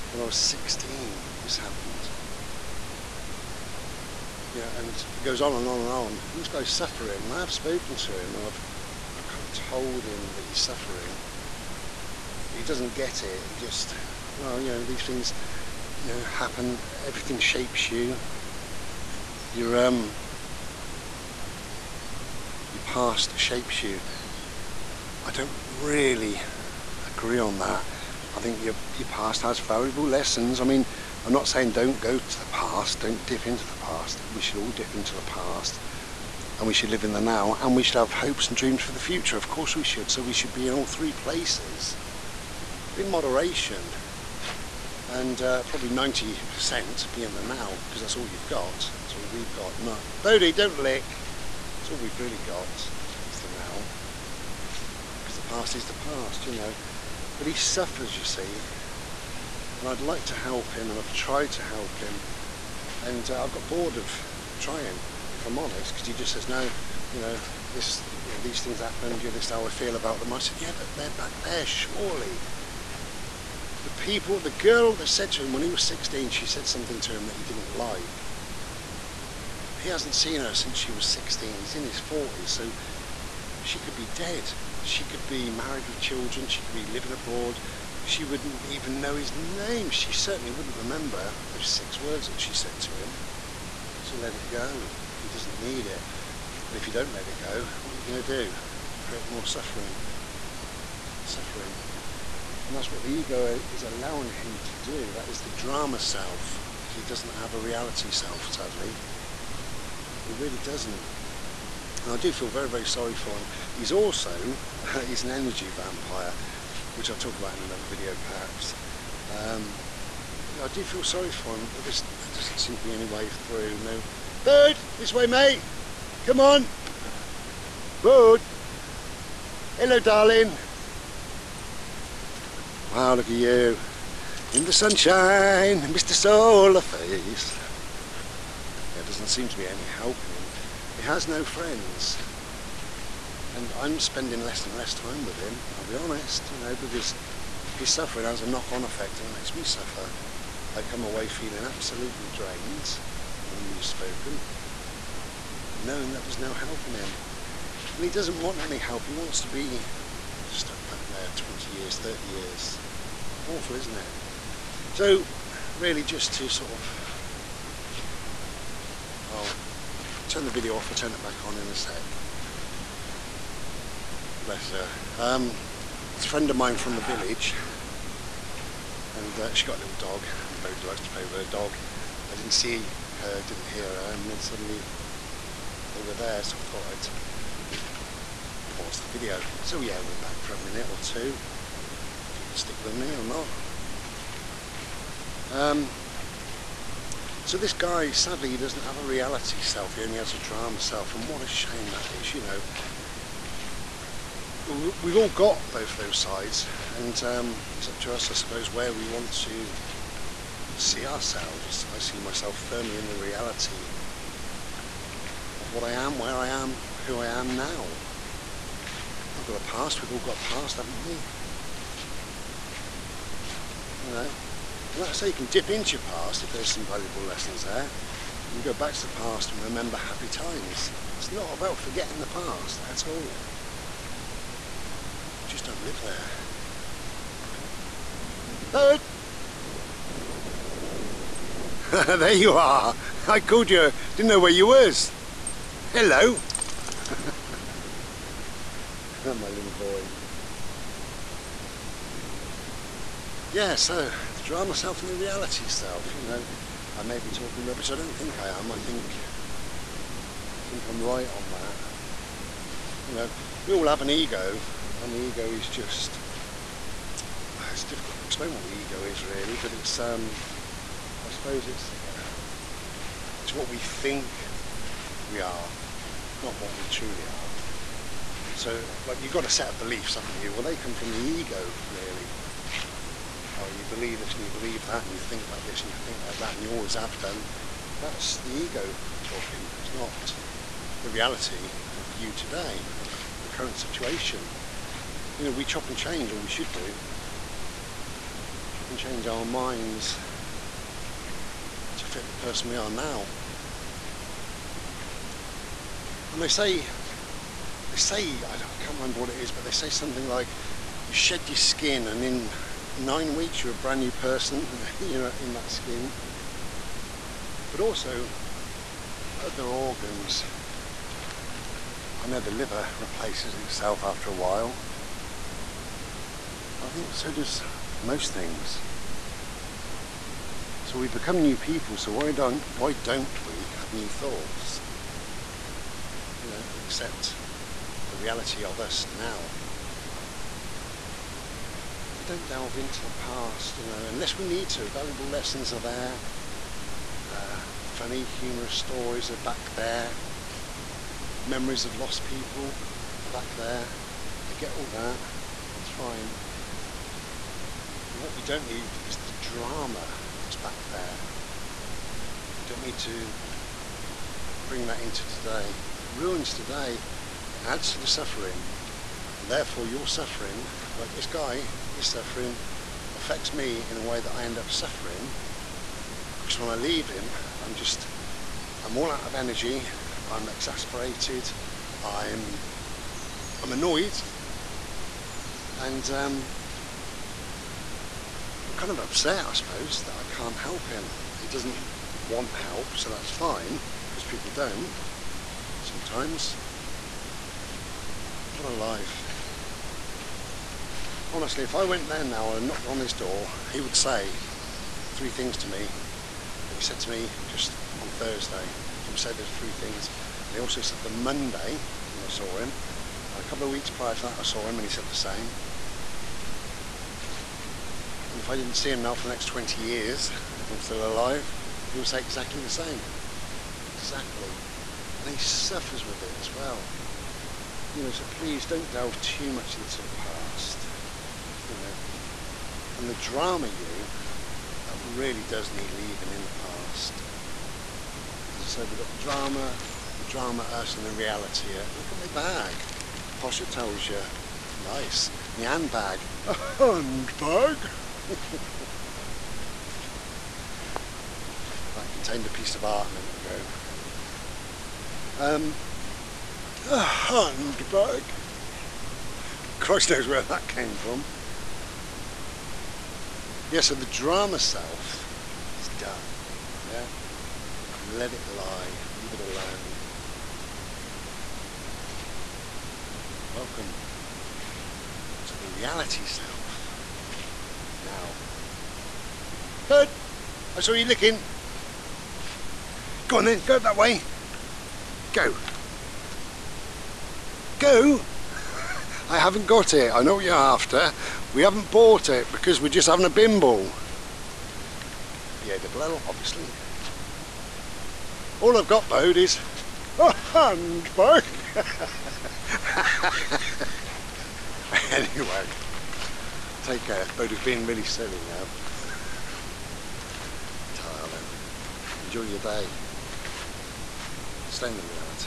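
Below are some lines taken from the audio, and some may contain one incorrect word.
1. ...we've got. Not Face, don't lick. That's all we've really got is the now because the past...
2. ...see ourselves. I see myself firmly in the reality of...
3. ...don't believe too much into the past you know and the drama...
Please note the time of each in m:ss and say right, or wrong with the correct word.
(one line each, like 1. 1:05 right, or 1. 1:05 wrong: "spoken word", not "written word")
1. 0:49 wrong: "Bodie", not "Face"
2. 3:30 right
3. 7:08 wrong: "delve", not "believe".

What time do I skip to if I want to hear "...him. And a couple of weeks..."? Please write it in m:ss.
6:52.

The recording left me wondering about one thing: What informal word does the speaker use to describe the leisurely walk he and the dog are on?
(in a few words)
Bimble.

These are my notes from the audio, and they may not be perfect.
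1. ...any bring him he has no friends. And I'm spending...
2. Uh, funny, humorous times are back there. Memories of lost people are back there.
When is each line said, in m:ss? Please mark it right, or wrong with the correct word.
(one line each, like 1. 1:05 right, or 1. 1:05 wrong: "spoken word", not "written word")
1. 2:19 wrong: "helping", not "bring"
2. 5:47 wrong: "stories", not "times".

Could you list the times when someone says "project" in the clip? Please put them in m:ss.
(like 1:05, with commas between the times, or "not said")
not said.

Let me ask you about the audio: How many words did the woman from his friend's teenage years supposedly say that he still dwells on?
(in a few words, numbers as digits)
6.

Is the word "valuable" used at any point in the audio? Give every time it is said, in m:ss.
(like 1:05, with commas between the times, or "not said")
0:29, 3:46, 5:44.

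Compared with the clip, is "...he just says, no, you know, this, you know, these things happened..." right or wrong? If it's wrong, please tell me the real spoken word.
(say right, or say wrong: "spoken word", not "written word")
right.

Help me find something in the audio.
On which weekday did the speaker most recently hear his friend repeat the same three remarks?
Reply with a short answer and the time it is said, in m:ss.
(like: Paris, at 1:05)
Thursday, at 6:48.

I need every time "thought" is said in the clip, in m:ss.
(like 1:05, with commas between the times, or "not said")
3:06, 5:34.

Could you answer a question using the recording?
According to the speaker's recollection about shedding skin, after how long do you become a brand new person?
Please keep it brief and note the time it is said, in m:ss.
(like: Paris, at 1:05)
9 weeks, at 5:12.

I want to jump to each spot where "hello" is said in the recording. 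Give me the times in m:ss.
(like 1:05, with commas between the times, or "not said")
2:09, 4:05.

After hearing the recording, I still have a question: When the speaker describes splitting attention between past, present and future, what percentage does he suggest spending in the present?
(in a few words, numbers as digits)
90%.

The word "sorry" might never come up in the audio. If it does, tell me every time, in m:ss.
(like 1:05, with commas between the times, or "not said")
1:52, 2:01.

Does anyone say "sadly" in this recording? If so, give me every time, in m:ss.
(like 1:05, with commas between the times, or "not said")
1:48, 3:18.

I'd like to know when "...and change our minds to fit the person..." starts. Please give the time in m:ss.
4:58.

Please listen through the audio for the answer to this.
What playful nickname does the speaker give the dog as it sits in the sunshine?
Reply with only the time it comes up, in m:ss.
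2:15.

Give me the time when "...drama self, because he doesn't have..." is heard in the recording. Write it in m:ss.
1:45.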